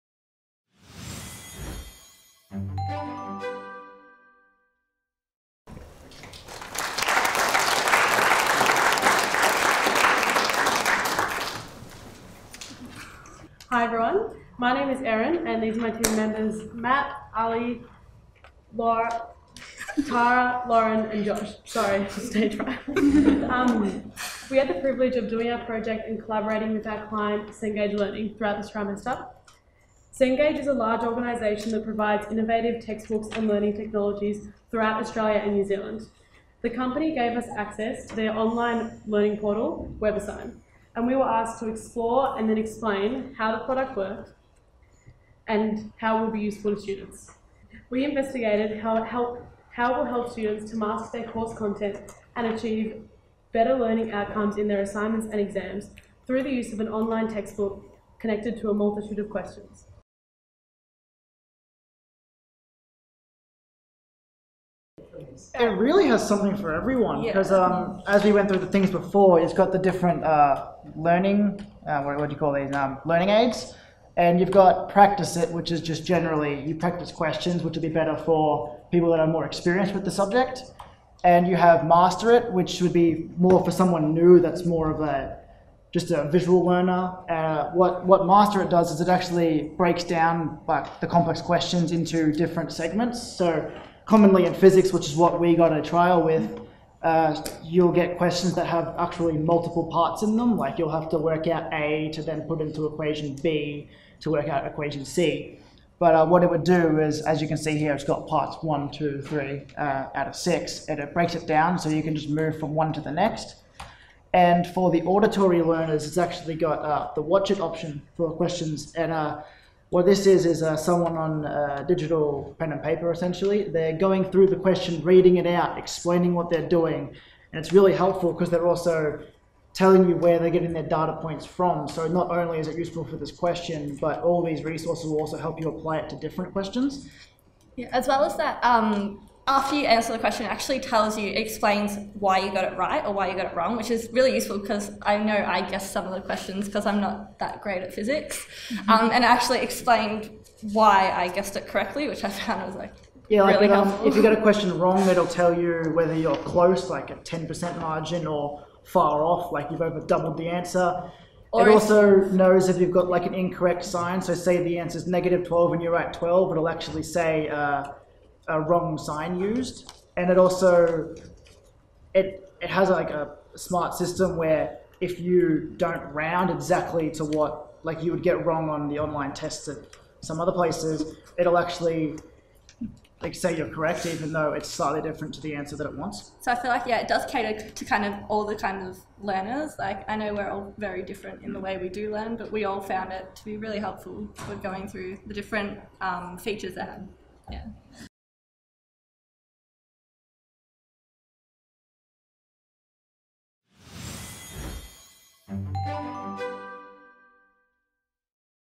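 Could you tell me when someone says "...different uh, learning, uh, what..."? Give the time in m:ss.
1:09.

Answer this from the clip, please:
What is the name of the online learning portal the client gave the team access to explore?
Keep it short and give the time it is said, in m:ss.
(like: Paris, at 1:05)
WebAssign, at 0:40.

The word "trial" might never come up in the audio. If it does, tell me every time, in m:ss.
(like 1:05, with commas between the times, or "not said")
1:35.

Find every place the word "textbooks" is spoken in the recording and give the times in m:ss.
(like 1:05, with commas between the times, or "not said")
0:32, 0:57.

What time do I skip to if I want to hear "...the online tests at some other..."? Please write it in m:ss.
2:58.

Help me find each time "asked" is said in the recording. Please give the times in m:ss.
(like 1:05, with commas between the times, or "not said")
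0:41.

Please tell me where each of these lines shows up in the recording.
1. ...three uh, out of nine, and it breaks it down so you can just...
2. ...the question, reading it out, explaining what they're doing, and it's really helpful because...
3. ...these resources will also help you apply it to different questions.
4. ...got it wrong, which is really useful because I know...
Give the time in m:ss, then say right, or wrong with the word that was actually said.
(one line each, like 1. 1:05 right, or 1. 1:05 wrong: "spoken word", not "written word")
1. 1:49 wrong: "six", not "nine"
2. 2:04 right
3. 2:14 right
4. 2:23 right.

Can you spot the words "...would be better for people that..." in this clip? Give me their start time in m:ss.
1:17.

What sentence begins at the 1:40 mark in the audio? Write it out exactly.
Like you'll have to work out A to then put into equation B to work out equation C.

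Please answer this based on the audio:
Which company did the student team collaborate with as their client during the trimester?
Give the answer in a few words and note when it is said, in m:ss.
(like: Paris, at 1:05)
Cengage Learning, at 0:27.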